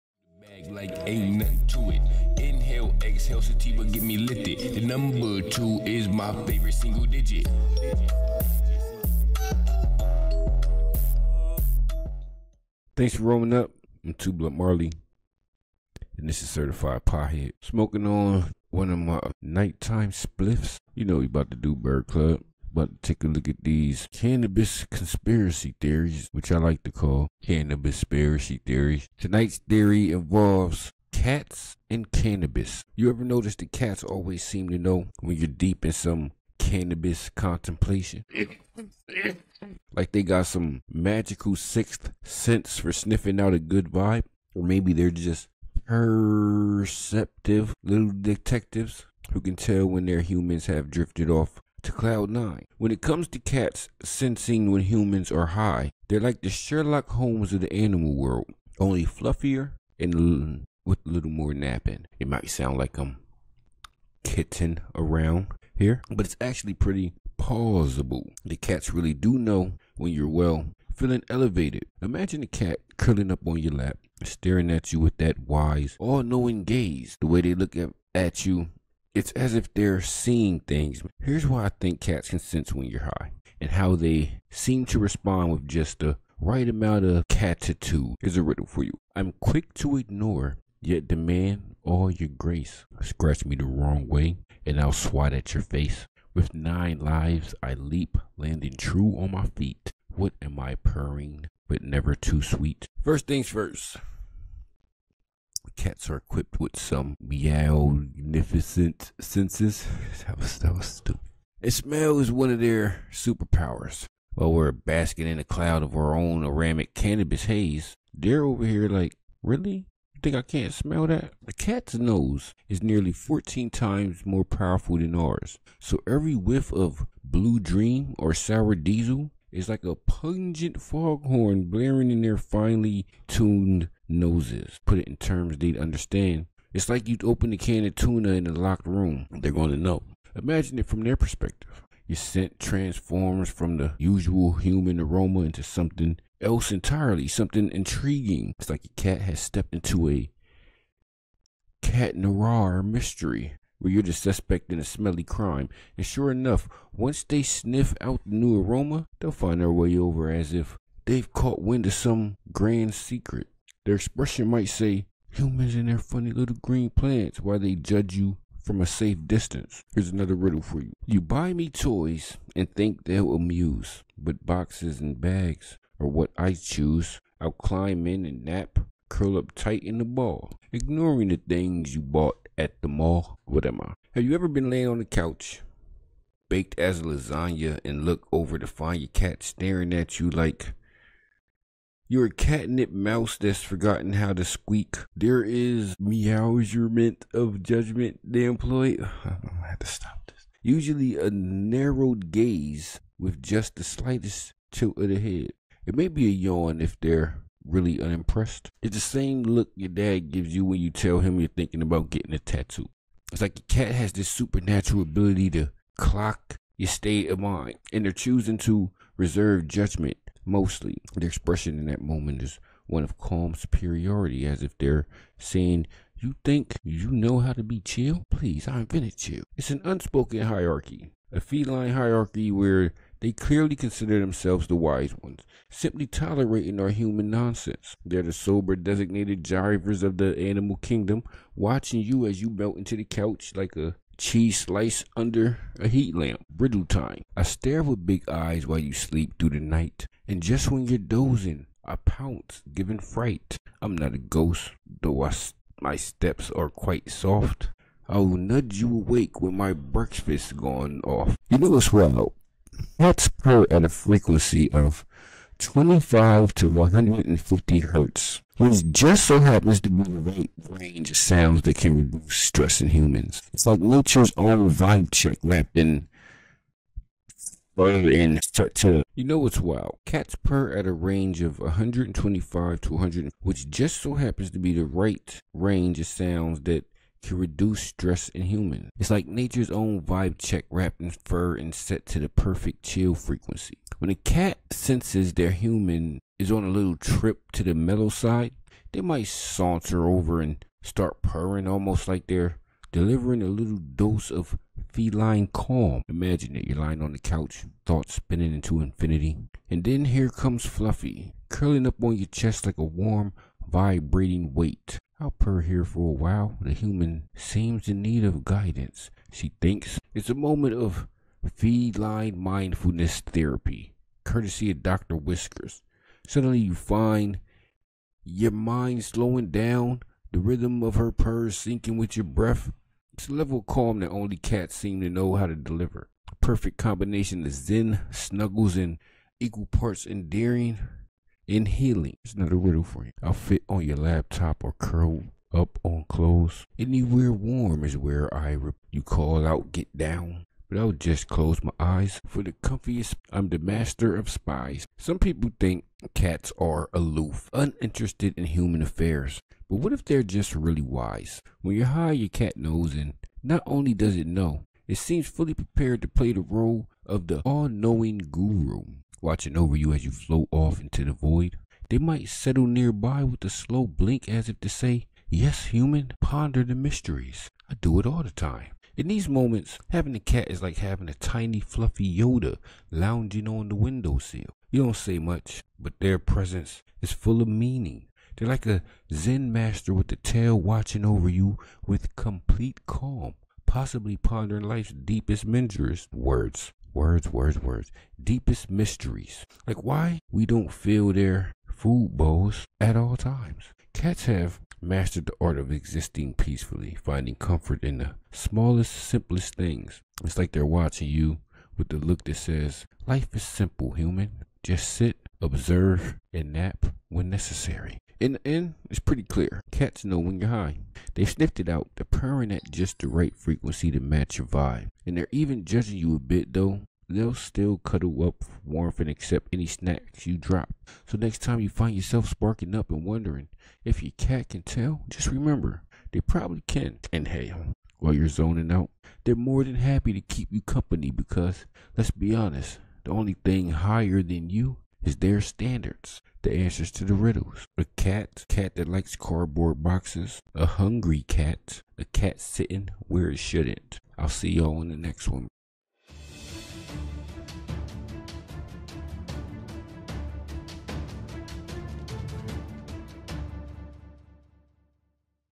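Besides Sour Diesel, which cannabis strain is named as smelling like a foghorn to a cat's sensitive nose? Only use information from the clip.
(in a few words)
Blue Dream.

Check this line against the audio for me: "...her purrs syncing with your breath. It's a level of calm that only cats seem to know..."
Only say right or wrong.
right.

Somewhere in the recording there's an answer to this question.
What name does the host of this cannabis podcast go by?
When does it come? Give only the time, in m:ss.
0:14.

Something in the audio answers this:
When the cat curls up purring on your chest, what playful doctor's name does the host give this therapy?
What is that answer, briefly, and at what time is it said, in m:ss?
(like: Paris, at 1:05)
Dr. Whiskers, at 5:24.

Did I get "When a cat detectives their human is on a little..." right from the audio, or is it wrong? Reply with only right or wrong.
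wrong.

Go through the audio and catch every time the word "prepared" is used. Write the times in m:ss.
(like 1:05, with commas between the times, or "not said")
6:05.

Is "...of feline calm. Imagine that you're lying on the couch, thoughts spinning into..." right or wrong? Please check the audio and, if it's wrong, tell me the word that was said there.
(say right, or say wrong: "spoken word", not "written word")
right.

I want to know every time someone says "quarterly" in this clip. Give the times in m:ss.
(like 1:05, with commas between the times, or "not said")
not said.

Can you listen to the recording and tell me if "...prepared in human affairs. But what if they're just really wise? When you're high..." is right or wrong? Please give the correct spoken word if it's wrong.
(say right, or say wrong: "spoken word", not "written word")
wrong: "uninterested", not "prepared".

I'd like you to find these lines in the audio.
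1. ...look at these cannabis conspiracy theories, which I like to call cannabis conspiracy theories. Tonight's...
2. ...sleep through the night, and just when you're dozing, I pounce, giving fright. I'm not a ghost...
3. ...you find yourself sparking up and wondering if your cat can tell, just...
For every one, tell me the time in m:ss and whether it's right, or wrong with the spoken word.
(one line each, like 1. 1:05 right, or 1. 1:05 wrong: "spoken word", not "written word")
1. 0:23 right
2. 4:08 right
3. 7:11 right.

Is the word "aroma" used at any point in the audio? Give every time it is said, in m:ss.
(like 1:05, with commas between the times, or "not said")
2:24, 2:38.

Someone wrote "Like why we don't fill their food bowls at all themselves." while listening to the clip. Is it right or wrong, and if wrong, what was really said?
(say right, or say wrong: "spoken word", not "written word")
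wrong: "times", not "themselves".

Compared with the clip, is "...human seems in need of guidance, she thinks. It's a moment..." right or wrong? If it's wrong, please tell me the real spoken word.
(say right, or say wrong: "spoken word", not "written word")
right.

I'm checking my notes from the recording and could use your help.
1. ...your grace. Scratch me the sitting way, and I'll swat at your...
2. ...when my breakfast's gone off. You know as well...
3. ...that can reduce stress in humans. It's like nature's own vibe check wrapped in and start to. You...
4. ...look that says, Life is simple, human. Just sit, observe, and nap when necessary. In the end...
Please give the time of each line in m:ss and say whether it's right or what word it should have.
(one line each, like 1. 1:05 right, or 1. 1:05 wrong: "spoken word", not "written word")
1. 1:32 wrong: "wrong", not "sitting"
2. 4:19 right
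3. 4:31 right
4. 6:51 right.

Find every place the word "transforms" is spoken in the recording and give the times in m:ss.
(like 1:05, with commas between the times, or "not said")
2:22.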